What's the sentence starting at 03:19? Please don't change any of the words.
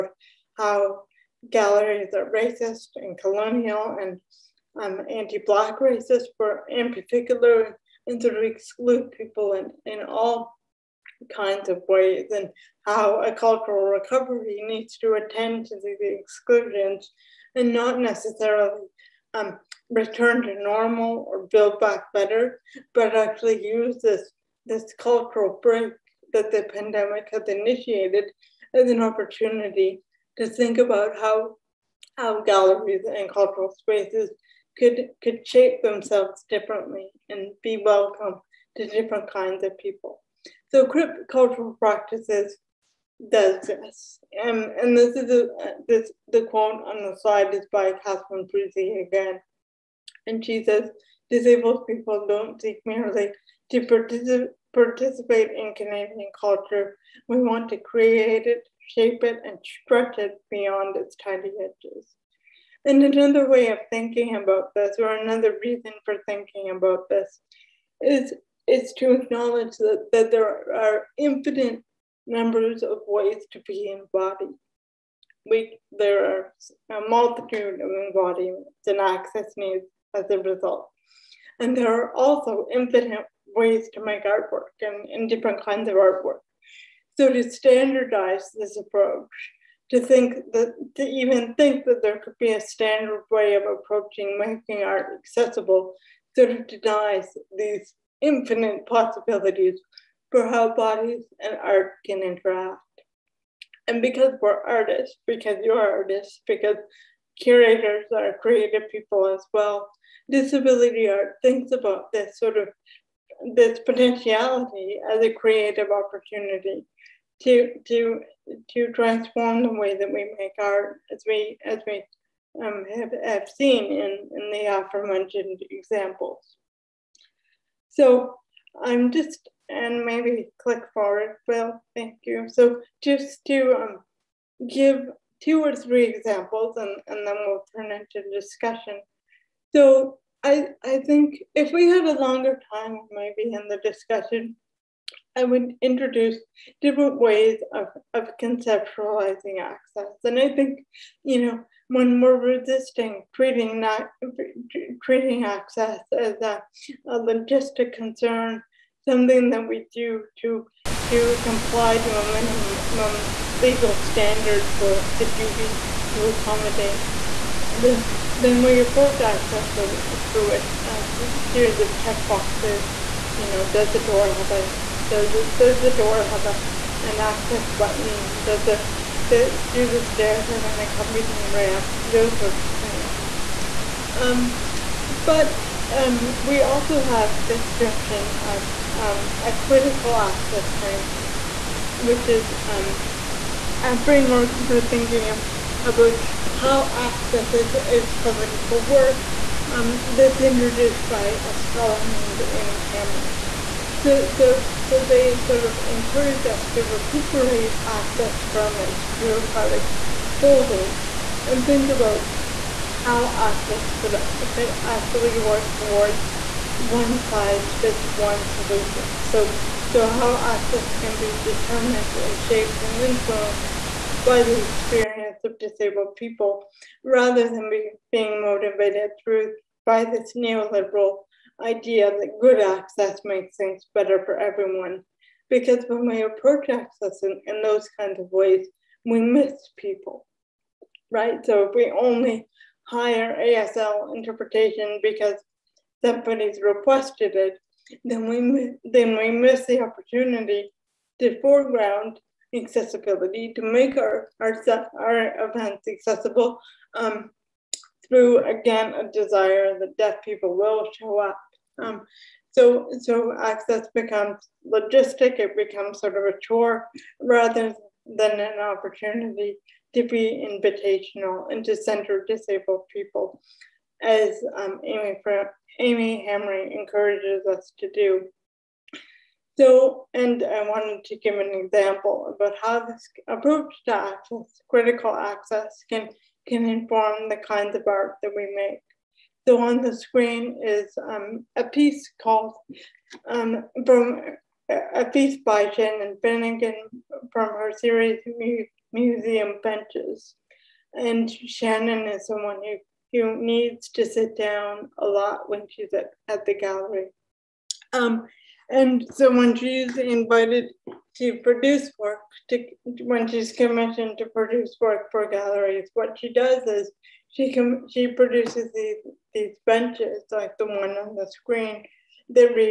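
Um, that's introduced by a scholar named Aimi Hamraie.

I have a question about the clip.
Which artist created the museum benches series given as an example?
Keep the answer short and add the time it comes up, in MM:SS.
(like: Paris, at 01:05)
Shannon Finnegan, at 04:55.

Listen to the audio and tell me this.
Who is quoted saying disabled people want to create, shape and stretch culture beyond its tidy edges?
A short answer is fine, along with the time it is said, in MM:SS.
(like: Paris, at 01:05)
Catherine Frazee, at 00:48.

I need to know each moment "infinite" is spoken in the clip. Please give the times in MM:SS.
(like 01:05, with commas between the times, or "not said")
01:11, 01:22, 01:38.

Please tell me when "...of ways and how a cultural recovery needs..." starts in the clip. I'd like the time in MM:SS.
00:11.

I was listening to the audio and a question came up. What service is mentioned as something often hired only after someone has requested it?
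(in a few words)
ASL interpretation.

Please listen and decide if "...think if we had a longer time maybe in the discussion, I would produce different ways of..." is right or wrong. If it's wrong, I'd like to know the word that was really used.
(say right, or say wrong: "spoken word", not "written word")
wrong: "introduce", not "produce".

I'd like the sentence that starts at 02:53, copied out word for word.
You know, does the door have a does it, does the door have a an access button?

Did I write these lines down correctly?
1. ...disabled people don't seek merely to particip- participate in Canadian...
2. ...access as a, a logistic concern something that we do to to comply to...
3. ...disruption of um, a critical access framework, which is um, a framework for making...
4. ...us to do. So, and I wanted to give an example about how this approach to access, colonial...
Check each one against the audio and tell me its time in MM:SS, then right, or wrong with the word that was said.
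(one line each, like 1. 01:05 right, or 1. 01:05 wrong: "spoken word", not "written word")
1. 00:51 right
2. 02:35 right
3. 03:07 wrong: "thinking", not "making"
4. 04:37 wrong: "critical", not "colonial".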